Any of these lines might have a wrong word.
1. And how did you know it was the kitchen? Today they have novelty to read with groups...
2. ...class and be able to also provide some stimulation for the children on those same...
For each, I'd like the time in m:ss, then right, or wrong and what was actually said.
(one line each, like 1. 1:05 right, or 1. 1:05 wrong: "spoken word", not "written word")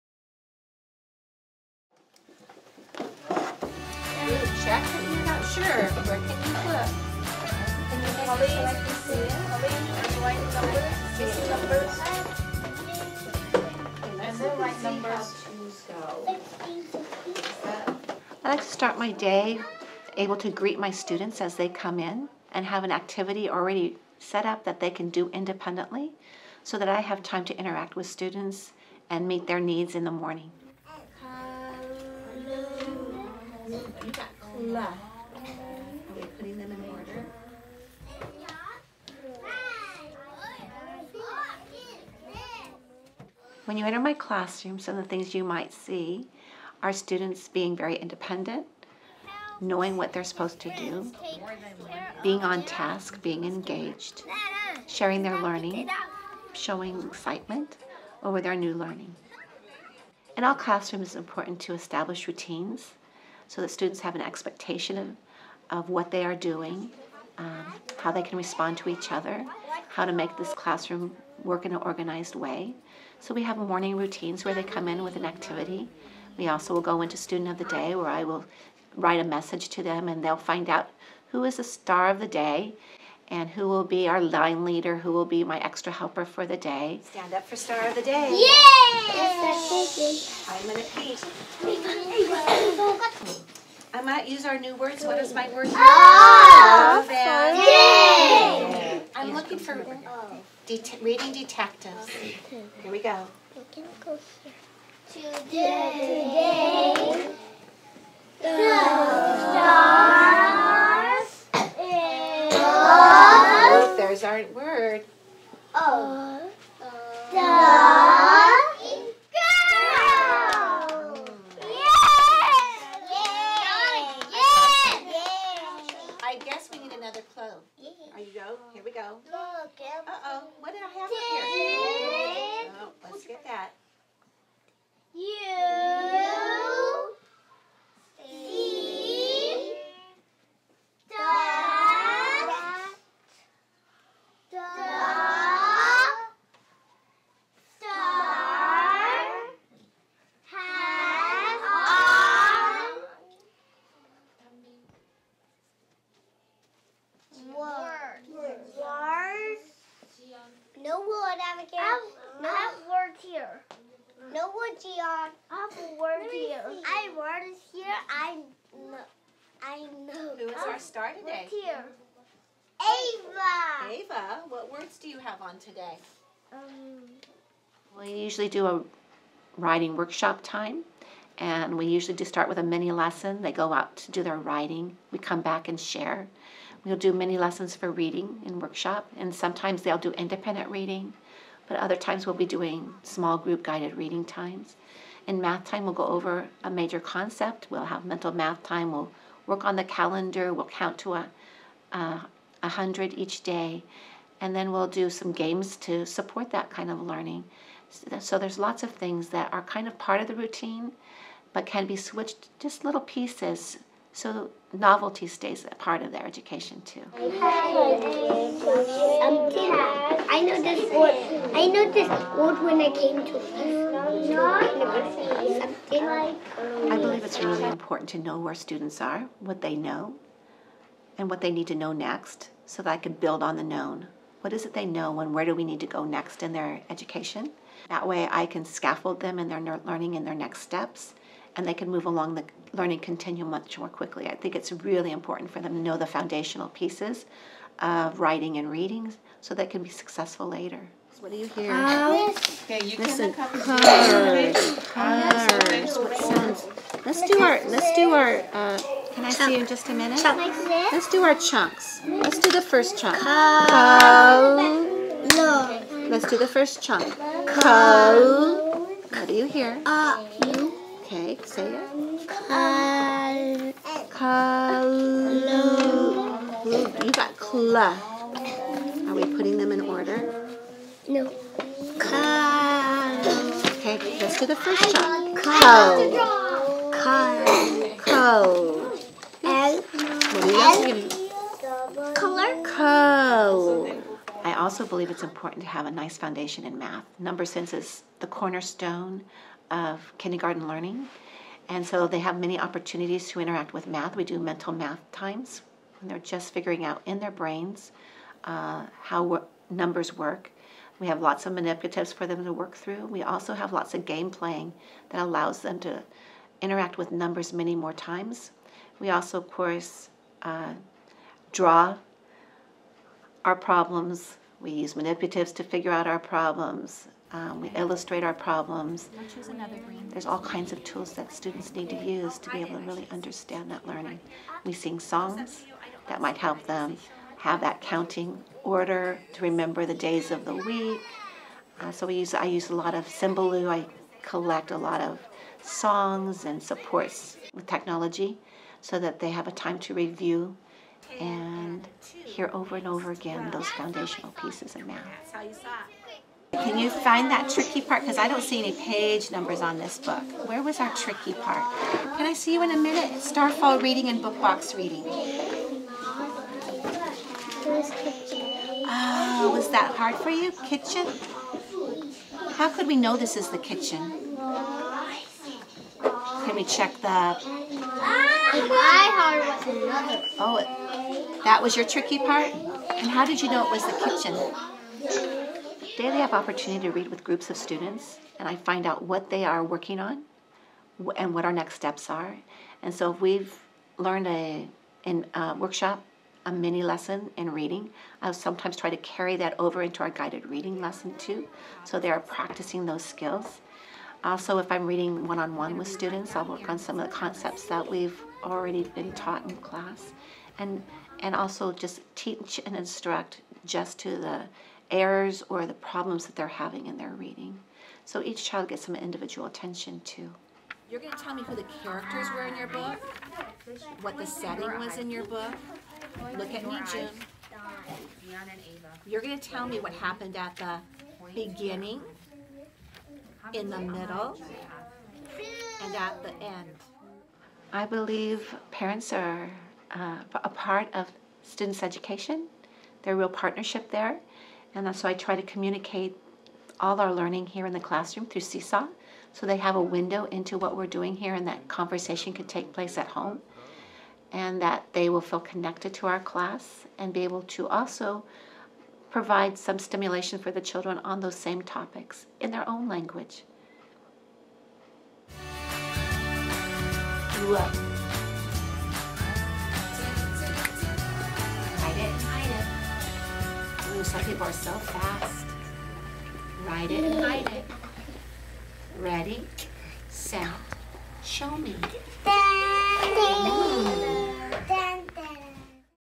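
1. 6:22 wrong: "opportunity", not "novelty"
2. 7:36 right.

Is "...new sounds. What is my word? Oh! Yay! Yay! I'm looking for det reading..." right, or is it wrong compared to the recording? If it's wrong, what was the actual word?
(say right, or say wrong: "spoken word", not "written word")
wrong: "words", not "sounds".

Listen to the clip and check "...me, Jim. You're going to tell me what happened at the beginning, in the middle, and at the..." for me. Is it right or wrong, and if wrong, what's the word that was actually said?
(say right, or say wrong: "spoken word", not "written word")
right.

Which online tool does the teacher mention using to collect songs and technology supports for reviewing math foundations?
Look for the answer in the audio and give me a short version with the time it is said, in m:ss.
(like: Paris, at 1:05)
Symbaloo, at 5:43.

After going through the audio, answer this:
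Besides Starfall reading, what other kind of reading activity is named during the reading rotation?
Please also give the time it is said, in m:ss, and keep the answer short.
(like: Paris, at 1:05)
book box reading, at 6:04.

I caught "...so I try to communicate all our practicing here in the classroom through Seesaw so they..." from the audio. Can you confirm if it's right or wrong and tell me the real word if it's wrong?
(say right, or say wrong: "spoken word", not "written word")
wrong: "learning", not "practicing".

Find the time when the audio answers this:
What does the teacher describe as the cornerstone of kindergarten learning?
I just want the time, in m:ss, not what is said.
4:57.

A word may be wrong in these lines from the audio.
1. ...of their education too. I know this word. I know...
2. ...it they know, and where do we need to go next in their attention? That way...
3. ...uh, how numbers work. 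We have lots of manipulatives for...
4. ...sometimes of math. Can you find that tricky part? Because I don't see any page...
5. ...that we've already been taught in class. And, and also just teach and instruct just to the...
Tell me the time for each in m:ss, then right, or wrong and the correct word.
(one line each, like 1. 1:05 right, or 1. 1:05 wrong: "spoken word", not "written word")
1. 3:36 right
2. 3:54 wrong: "education", not "attention"
3. 5:08 right
4. 5:54 wrong: "pieces", not "sometimes"
5. 6:47 right.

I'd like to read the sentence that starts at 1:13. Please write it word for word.
So we have morning routines where they come in with an activity.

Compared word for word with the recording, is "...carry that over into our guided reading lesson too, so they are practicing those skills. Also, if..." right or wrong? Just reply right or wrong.
right.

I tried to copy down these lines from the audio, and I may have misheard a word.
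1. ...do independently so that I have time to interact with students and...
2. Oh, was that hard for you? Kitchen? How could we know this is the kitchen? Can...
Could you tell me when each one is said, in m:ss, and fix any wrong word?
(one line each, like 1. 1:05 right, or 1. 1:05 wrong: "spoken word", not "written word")
1. 0:25 right
2. 6:08 right.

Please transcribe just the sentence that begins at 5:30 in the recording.
There's all kinds of tools that students need to use to be able to really understand that learning.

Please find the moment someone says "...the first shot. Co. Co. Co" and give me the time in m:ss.
4:44.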